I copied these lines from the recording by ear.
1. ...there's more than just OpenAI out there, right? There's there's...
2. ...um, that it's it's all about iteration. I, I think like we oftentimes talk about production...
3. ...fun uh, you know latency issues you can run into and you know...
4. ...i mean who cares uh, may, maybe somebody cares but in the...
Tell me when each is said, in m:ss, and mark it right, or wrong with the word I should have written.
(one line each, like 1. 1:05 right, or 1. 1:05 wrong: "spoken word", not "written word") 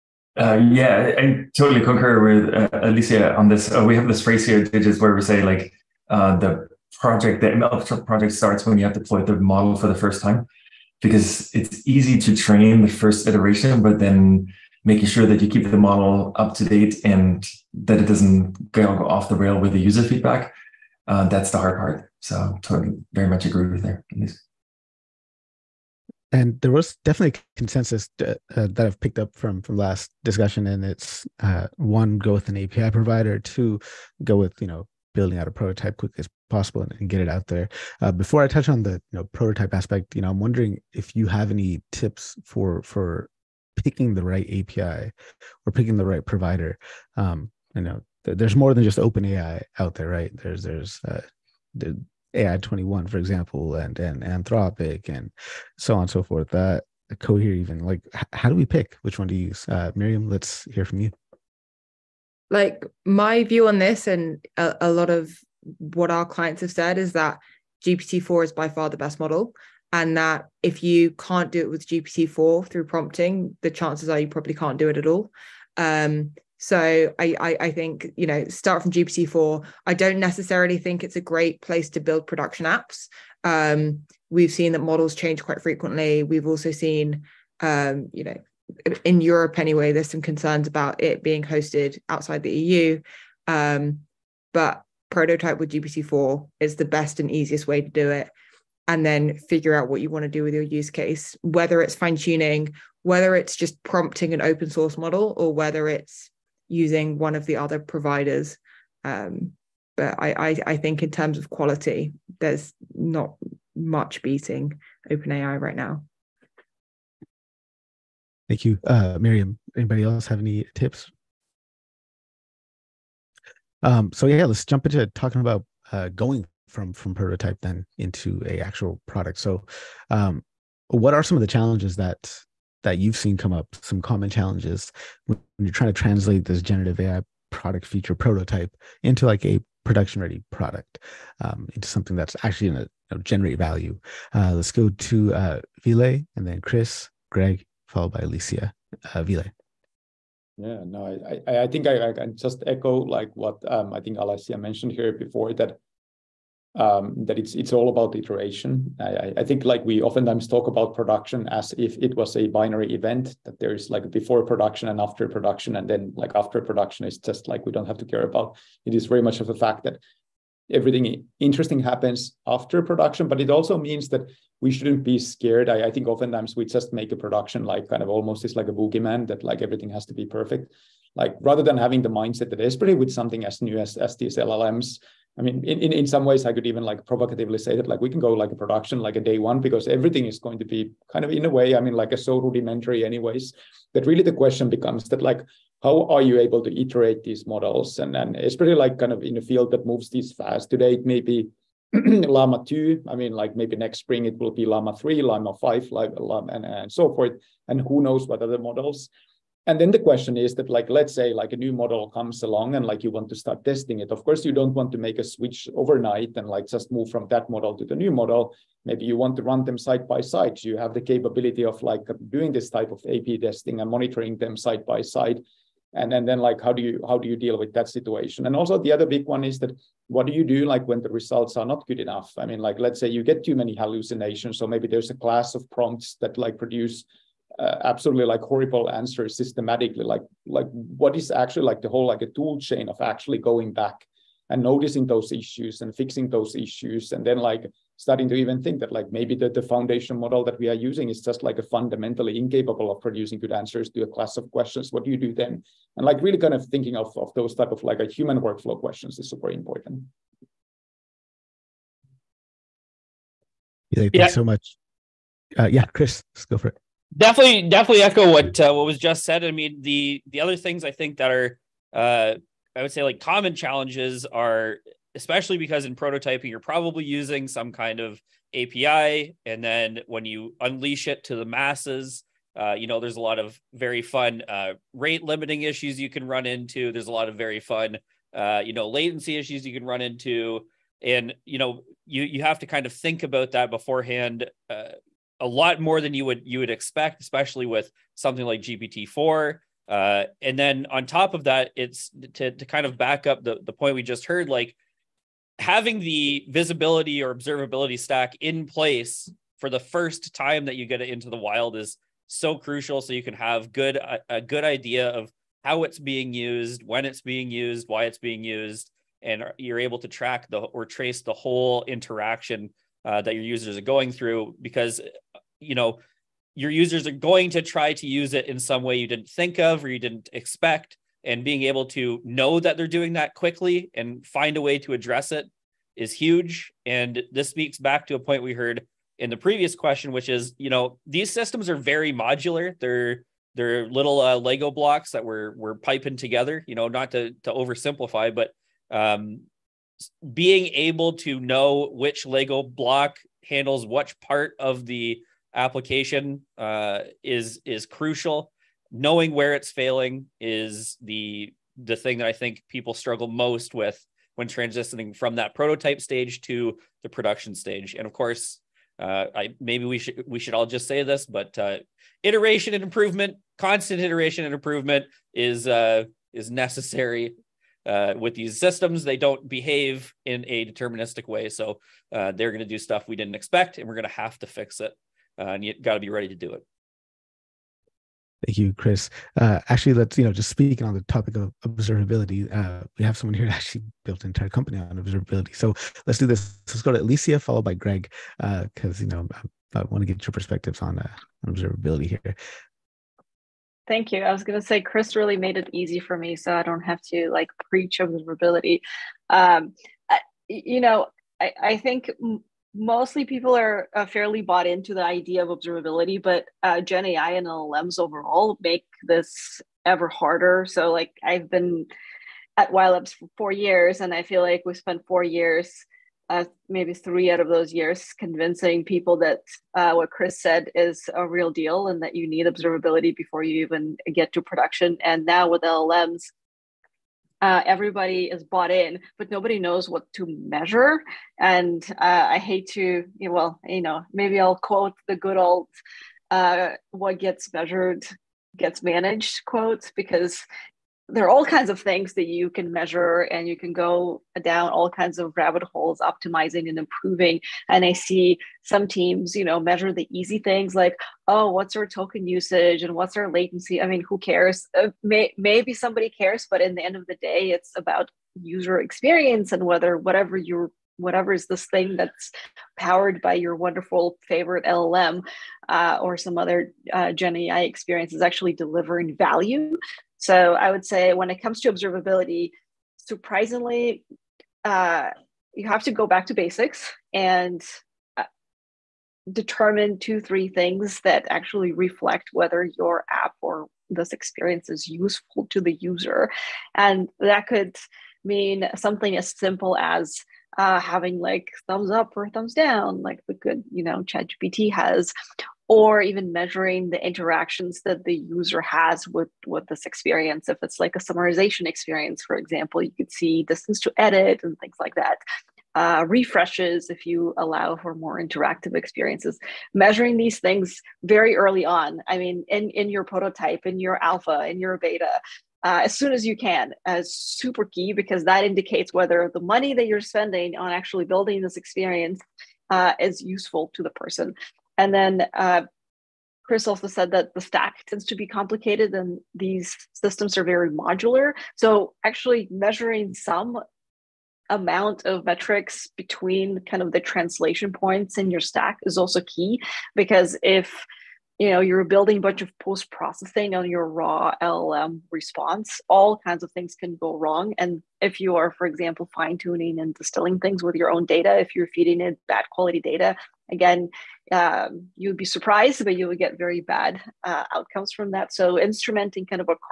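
1. 0:48 right
2. 2:36 right
3. 4:47 right
4. 7:43 right.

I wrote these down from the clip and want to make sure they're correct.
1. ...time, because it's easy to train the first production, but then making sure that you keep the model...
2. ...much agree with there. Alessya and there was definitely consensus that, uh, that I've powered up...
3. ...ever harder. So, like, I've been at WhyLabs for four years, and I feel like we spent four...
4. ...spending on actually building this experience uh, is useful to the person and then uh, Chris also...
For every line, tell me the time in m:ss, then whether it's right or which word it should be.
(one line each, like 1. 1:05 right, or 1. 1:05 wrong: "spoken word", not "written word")
1. 0:10 wrong: "iteration", not "production"
2. 0:23 wrong: "picked", not "powered"
3. 6:59 right
4. 8:49 right.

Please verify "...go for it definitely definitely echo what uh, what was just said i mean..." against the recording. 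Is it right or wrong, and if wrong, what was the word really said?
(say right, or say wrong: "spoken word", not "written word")
right.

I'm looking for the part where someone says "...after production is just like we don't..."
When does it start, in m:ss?
2:46.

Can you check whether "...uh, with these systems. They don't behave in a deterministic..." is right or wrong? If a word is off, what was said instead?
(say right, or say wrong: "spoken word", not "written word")
right.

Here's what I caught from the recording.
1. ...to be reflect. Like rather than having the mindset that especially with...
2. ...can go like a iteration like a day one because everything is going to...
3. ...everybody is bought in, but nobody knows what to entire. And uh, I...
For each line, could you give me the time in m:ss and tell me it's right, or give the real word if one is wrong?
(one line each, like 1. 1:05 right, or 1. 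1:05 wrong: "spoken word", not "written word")
1. 3:00 wrong: "perfect", not "reflect"
2. 3:08 wrong: "production", not "iteration"
3. 7:17 wrong: "measure", not "entire".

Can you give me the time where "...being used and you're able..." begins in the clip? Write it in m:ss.
5:18.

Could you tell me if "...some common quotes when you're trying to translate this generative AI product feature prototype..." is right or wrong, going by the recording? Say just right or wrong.
wrong.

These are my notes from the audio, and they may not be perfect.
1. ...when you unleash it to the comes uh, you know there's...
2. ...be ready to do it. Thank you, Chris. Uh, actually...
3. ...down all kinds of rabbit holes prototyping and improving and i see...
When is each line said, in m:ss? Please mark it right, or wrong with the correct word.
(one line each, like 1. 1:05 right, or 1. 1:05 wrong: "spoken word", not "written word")
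1. 4:40 wrong: "masses", not "comes"
2. 6:25 right
3. 7:34 wrong: "optimizing", not "prototyping".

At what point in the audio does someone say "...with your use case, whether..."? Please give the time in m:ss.
1:40.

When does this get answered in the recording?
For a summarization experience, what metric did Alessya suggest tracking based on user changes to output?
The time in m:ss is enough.
8:33.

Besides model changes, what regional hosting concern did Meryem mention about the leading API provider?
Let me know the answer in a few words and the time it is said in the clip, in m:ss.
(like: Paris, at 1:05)
Hosted outside the EU, at 1:31.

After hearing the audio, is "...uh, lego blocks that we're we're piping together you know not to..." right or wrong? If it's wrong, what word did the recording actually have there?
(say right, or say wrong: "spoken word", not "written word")
right.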